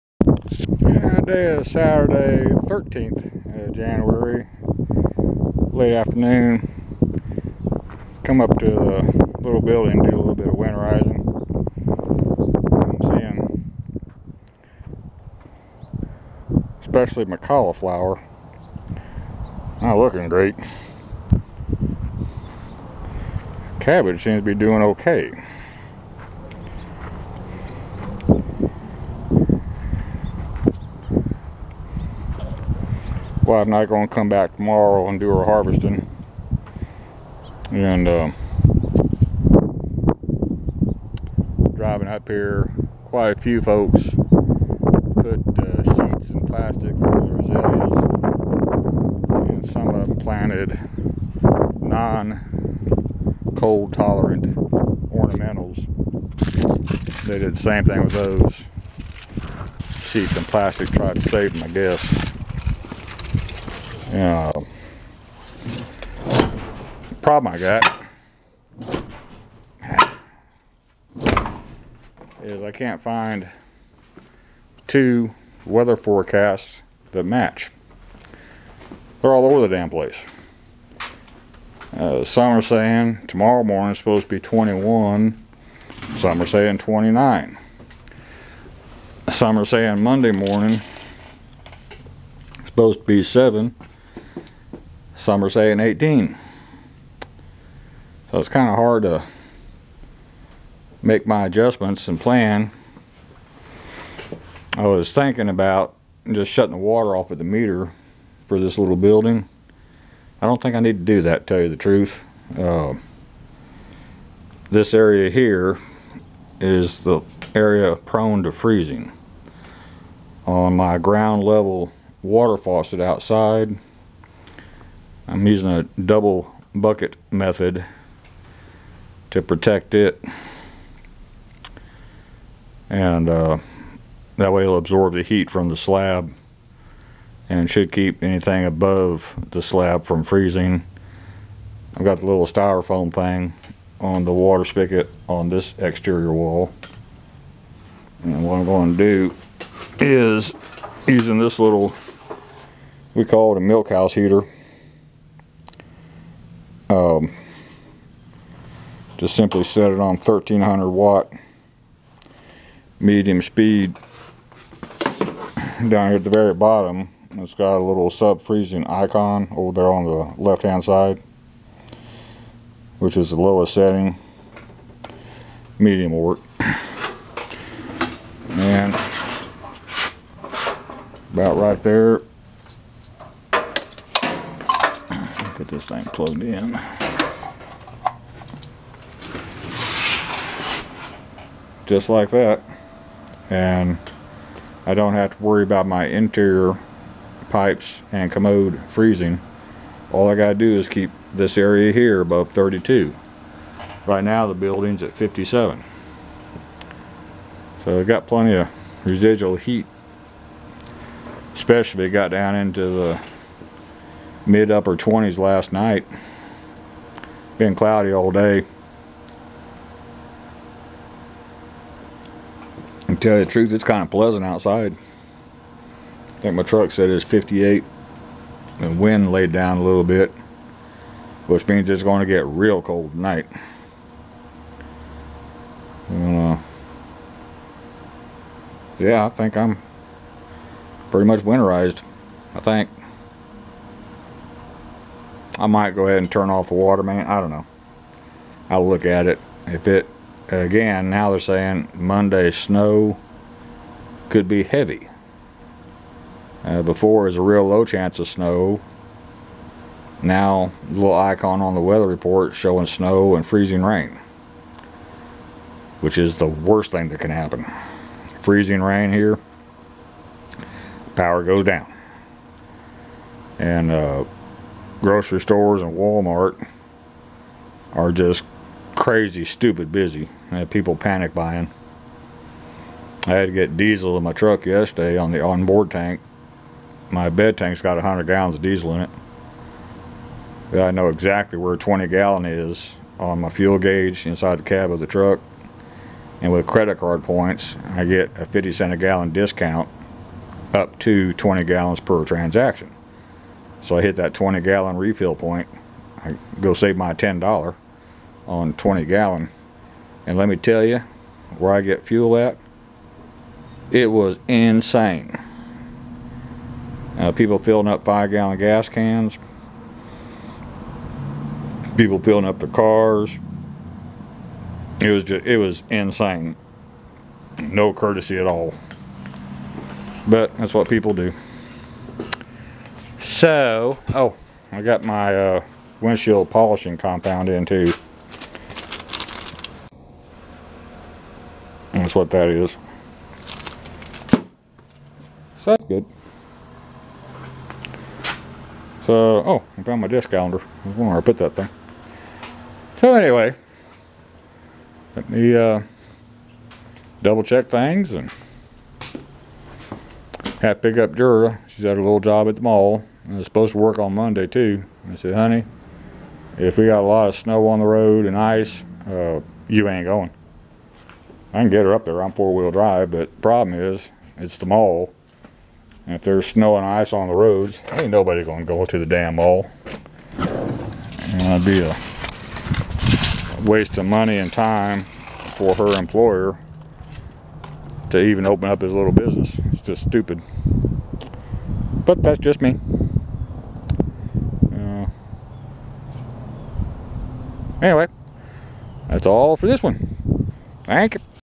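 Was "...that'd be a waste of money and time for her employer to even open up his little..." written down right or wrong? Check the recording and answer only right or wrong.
right.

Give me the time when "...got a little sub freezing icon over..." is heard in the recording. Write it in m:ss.
2:47.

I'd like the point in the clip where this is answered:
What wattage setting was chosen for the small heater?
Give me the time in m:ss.
2:40.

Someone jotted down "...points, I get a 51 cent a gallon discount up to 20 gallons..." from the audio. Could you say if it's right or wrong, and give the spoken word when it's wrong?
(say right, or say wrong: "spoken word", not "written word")
wrong: "50", not "51".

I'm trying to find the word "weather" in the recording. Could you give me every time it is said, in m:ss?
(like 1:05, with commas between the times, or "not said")
1:15, 4:21.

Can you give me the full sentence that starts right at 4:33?
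And uh, grocery stores and Walmart are just crazy, stupid busy.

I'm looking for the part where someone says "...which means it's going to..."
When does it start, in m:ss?
3:51.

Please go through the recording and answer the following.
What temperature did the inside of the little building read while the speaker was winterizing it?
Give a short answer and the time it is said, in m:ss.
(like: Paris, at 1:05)
57, at 3:25.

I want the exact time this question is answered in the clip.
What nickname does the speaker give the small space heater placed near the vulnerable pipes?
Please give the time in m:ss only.
2:33.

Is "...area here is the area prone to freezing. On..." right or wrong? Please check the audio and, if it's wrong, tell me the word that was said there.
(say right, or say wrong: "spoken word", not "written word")
right.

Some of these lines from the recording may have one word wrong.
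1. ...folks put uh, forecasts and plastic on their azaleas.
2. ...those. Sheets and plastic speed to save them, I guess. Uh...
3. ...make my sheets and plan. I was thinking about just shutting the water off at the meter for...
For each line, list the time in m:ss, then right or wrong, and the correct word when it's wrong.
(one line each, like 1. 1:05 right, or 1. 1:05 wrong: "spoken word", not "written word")
1. 0:43 wrong: "sheets", not "forecasts"
2. 0:58 wrong: "tried", not "speed"
3. 1:41 wrong: "adjustments", not "sheets".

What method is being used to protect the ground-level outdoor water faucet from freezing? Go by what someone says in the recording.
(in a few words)
Double bucket method.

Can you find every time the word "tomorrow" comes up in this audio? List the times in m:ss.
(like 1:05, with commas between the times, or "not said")
0:34, 1:23.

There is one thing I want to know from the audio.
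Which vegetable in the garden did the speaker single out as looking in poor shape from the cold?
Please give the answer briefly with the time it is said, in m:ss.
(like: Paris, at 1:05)
Cauliflower, at 0:17.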